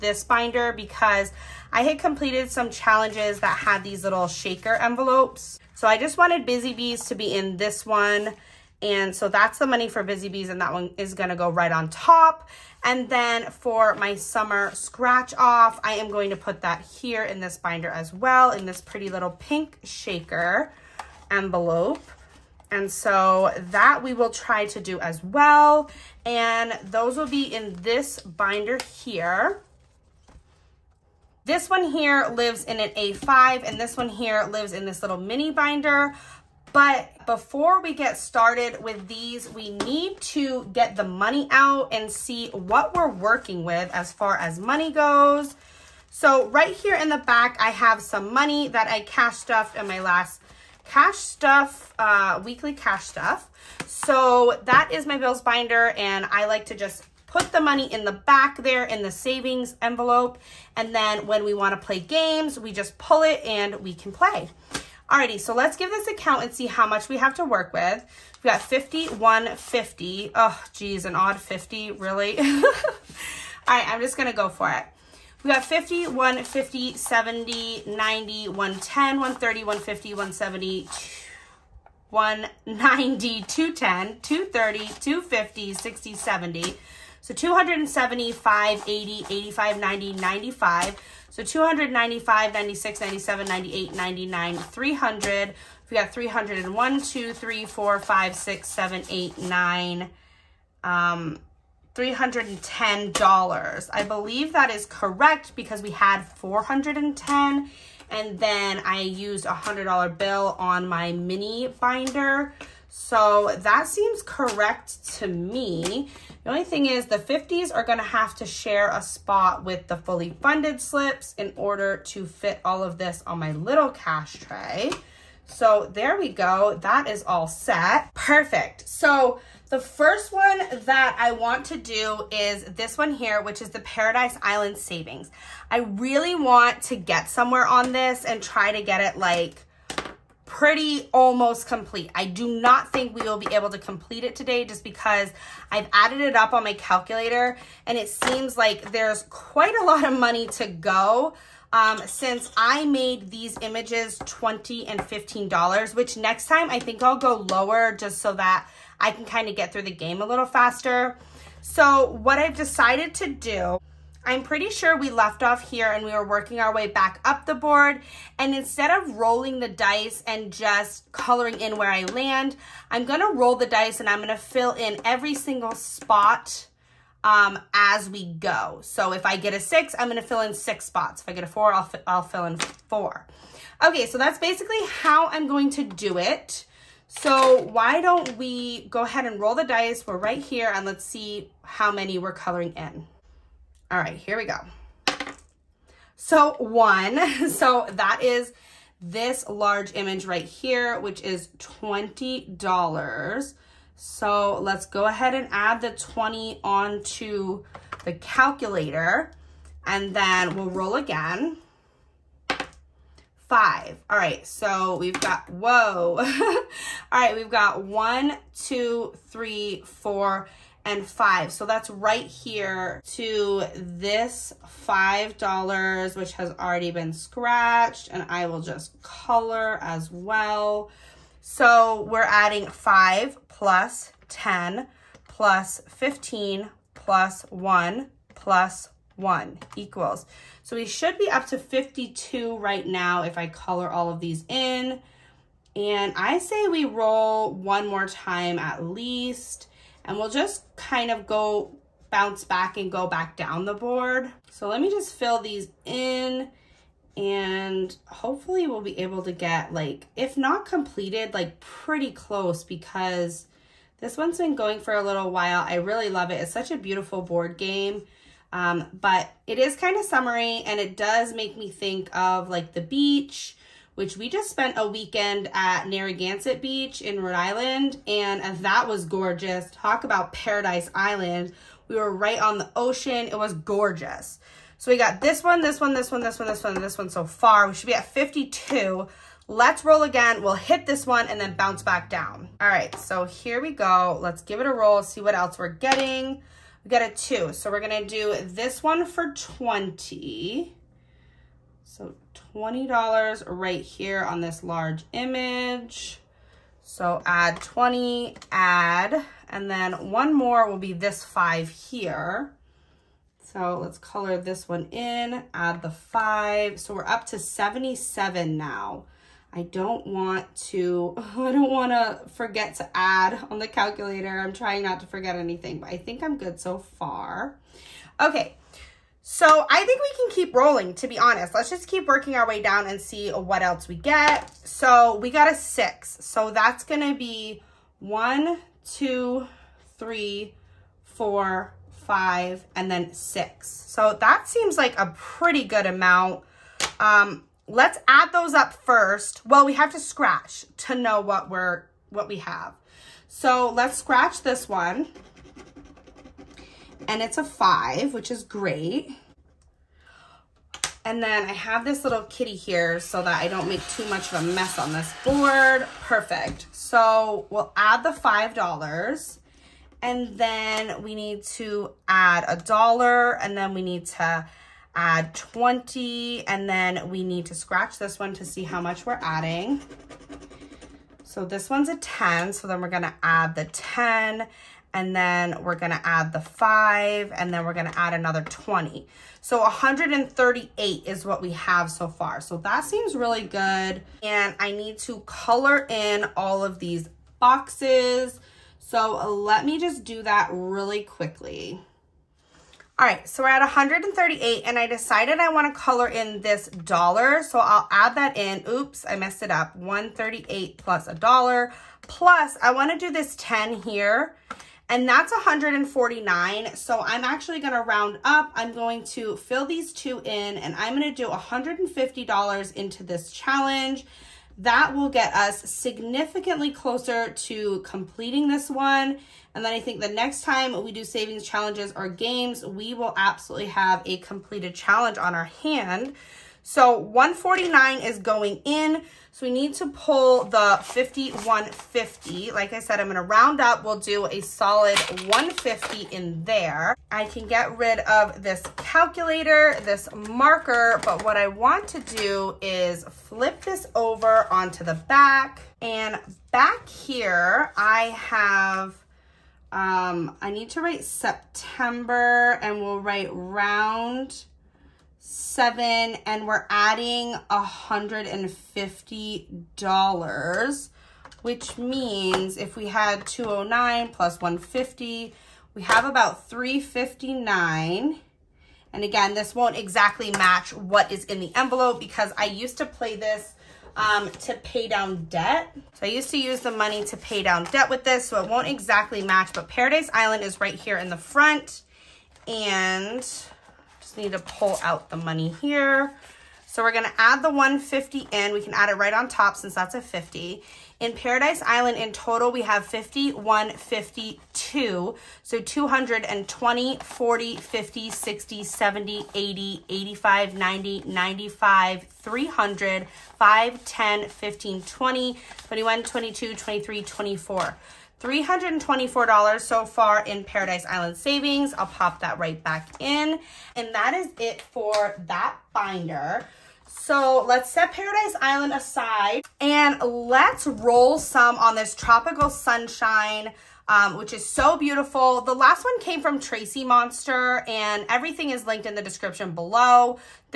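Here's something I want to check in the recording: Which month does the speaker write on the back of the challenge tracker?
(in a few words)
September.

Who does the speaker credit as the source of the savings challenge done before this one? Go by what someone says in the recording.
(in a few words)
Tracy Monster.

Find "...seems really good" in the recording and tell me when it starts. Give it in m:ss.
6:32.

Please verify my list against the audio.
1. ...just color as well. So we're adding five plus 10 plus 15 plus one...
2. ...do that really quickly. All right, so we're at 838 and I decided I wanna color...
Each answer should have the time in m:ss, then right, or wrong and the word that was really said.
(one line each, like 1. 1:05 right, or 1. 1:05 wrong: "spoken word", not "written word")
1. 3:48 right
2. 6:40 wrong: "138", not "838".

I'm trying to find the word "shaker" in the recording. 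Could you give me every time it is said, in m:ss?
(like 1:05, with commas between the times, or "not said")
0:04, 0:19.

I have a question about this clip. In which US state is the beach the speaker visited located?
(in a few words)
Rhode Island.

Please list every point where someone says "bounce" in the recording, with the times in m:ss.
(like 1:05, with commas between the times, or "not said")
4:12, 4:51.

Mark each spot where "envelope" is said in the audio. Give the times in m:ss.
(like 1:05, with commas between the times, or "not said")
0:04, 0:21, 0:59, 8:01.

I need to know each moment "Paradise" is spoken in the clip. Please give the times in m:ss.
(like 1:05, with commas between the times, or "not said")
2:13, 4:40, 8:09, 8:40, 8:47.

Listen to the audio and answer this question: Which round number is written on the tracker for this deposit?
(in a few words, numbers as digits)
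seven.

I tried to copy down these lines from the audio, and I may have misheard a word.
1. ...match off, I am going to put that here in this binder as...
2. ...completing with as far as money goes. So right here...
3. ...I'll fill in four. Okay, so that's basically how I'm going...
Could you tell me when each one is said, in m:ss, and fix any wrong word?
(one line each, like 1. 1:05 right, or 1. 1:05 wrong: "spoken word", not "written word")
1. 0:14 wrong: "scratch", not "match"
2. 0:43 wrong: "working", not "completing"
3. 3:02 right.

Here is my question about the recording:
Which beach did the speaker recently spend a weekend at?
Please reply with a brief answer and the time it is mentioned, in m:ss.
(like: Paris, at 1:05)
Narragansett Beach, at 4:35.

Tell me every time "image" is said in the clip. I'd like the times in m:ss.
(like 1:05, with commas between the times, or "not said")
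2:33, 3:19, 5:05.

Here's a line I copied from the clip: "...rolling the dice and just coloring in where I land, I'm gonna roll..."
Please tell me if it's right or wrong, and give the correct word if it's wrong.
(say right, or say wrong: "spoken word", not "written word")
right.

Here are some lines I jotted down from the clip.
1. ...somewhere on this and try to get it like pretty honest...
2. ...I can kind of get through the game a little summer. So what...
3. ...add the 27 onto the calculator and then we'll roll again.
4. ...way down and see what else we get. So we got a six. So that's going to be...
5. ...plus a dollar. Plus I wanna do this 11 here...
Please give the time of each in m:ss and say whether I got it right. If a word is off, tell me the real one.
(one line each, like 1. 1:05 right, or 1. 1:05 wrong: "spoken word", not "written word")
1. 2:17 wrong: "almost", not "honest"
2. 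2:38 wrong: "faster", not "summer"
3. 3:25 wrong: "20", not "27"
4. 5:32 right
5. 6:50 wrong: "10", not "11".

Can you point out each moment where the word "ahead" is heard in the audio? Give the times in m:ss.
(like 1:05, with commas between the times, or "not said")
3:09, 3:25.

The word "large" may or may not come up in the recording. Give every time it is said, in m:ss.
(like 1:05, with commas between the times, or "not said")
3:19, 5:04.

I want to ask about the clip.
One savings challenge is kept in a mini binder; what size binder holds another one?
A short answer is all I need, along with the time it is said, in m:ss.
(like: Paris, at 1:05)
A5, at 0:32.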